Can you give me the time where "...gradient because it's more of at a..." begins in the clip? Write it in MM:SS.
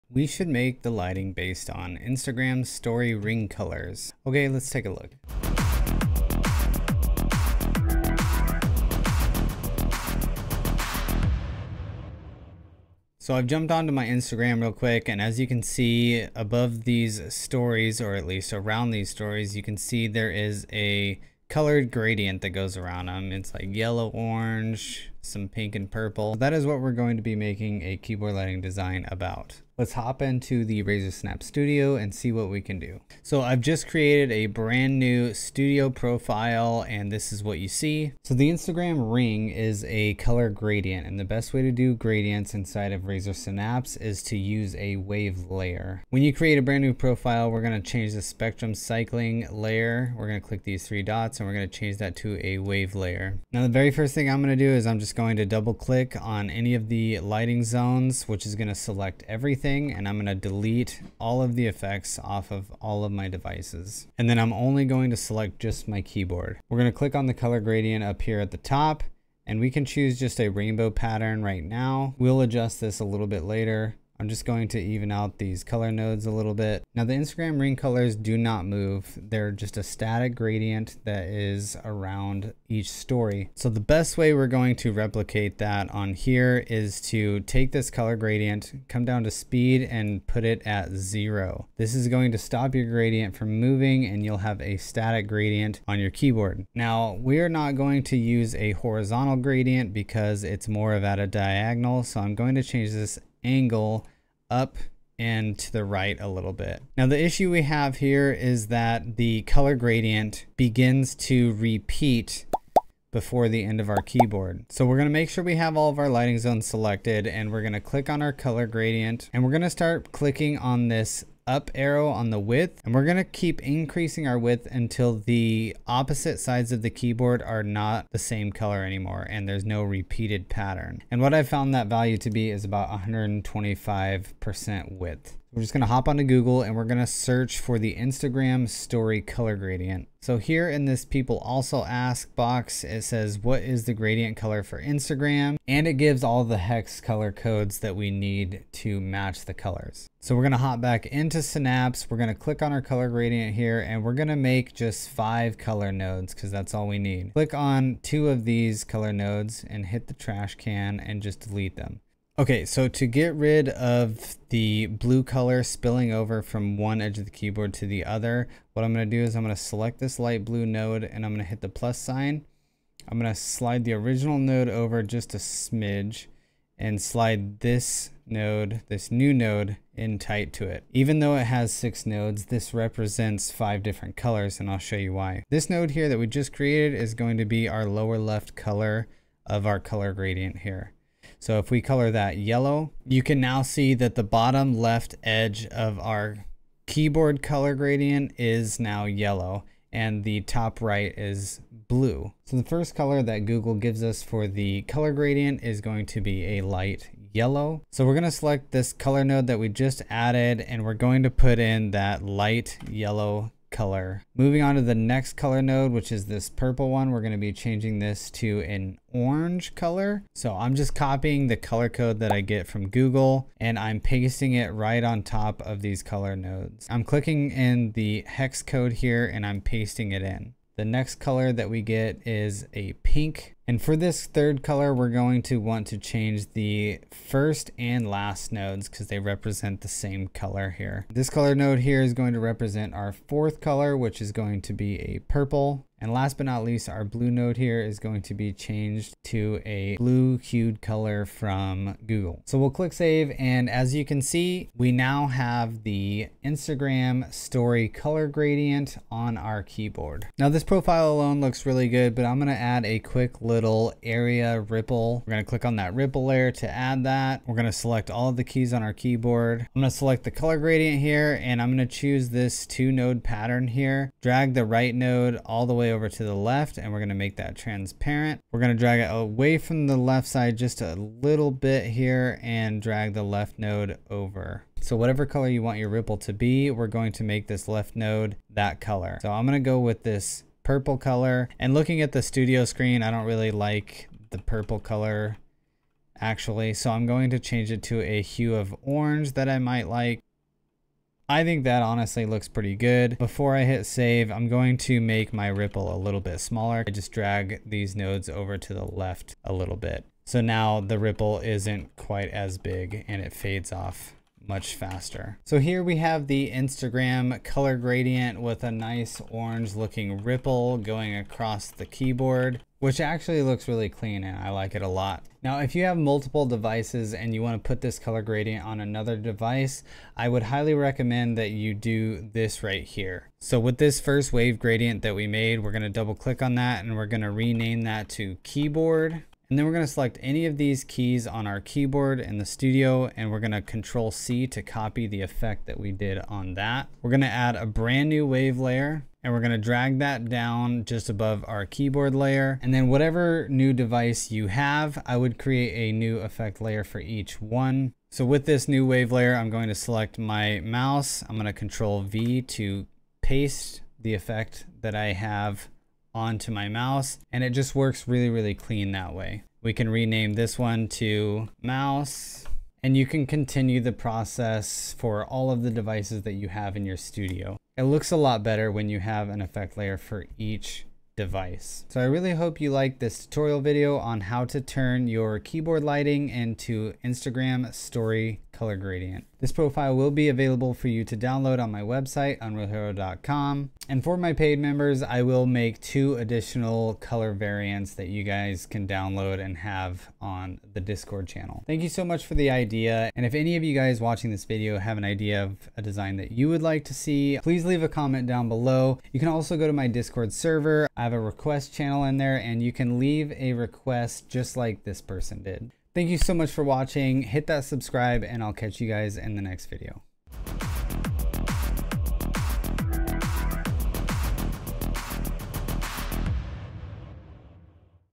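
01:39.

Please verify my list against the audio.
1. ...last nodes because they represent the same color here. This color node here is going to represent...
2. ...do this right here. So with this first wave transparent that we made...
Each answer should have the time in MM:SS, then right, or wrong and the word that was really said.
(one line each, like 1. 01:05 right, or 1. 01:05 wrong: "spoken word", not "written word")
1. 03:58 right
2. 05:31 wrong: "gradient", not "transparent".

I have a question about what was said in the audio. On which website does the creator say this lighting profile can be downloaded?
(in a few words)
unrealhero.com.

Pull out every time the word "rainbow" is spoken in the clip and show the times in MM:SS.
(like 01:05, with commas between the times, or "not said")
01:10.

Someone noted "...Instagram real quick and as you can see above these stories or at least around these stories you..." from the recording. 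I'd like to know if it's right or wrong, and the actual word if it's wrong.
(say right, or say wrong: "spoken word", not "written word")
right.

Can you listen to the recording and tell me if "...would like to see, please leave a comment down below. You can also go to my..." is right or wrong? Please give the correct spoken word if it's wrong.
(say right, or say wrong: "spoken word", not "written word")
right.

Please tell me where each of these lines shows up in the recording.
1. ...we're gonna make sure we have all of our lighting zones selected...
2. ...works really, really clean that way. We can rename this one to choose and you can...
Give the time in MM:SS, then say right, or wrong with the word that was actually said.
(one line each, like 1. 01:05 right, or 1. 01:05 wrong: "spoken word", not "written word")
1. 01:54 right
2. 06:07 wrong: "mouse", not "choose".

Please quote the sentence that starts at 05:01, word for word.
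I think that honestly looks pretty good.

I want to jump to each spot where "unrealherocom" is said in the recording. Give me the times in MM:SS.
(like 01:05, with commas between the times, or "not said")
06:32.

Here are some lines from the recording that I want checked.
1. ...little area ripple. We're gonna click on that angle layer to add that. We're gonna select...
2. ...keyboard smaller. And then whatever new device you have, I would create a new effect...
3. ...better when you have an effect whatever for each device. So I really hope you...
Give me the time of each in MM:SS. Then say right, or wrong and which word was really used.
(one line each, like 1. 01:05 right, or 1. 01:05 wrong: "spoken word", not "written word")
1. 04:23 wrong: "ripple", not "angle"
2. 05:51 wrong: "layer", not "smaller"
3. 06:18 wrong: "layer", not "whatever".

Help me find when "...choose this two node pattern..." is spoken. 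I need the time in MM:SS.
04:31.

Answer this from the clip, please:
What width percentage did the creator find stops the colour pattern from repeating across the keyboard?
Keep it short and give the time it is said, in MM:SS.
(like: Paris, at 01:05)
125%, at 02:13.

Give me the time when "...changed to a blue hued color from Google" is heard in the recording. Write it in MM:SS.
04:08.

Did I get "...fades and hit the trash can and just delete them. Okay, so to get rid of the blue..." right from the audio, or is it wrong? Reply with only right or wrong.
wrong.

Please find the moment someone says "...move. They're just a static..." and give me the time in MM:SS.
01:18.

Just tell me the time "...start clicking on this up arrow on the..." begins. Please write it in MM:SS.
01:59.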